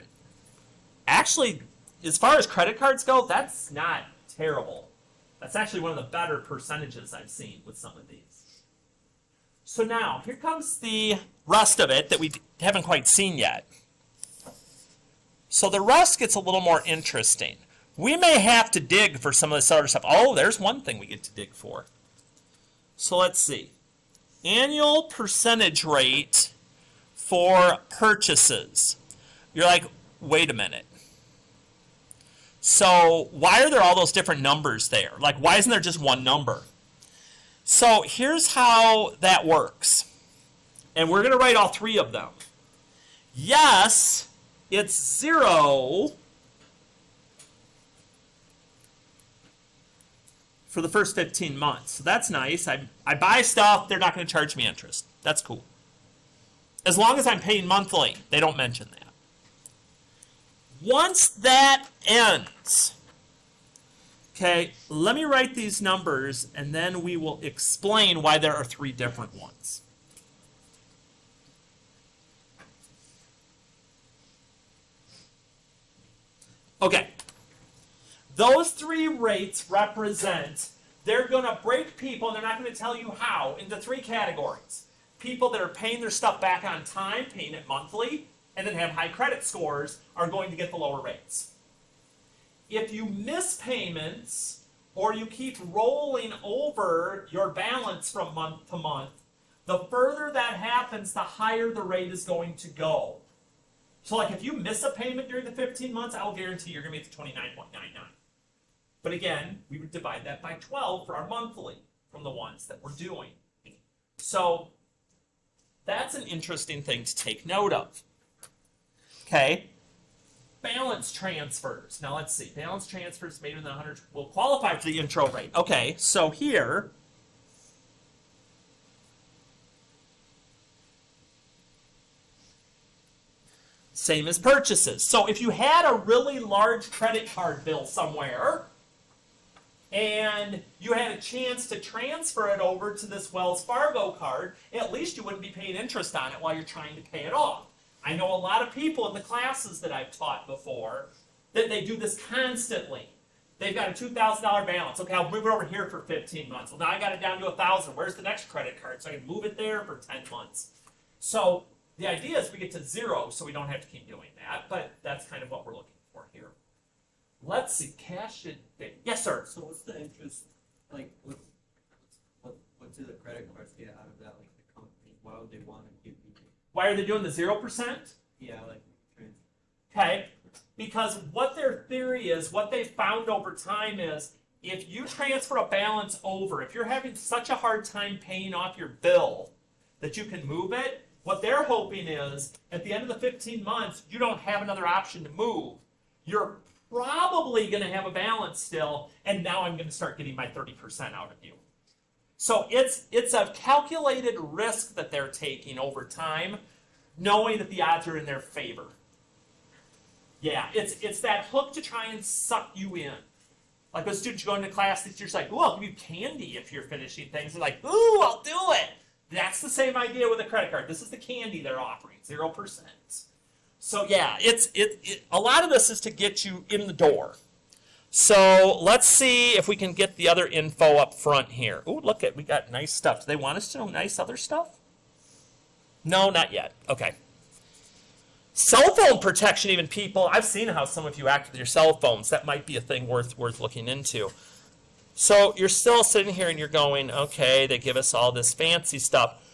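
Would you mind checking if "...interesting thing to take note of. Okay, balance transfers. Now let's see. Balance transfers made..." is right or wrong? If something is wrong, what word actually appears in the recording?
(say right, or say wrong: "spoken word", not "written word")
right.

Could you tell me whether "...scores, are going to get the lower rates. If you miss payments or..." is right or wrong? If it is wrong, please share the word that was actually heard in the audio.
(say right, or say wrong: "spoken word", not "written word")
right.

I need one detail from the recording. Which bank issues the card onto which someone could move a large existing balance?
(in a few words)
Wells Fargo.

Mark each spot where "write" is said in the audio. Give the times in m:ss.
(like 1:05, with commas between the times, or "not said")
0:41, 1:05.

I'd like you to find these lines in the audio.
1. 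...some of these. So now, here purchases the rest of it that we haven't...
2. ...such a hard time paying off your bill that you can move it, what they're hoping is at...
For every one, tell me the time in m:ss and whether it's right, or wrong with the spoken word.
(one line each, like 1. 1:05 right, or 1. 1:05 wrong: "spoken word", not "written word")
1. 0:07 wrong: "comes", not "purchases"
2. 3:07 right.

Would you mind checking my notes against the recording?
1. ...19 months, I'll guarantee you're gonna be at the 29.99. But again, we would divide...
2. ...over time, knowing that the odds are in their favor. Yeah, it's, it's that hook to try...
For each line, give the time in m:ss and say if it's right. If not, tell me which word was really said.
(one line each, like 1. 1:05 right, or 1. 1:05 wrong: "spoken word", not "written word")
1. 1:45 wrong: "15", not "19"
2. 3:25 right.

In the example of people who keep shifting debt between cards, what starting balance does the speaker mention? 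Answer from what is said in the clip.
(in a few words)
$2,000.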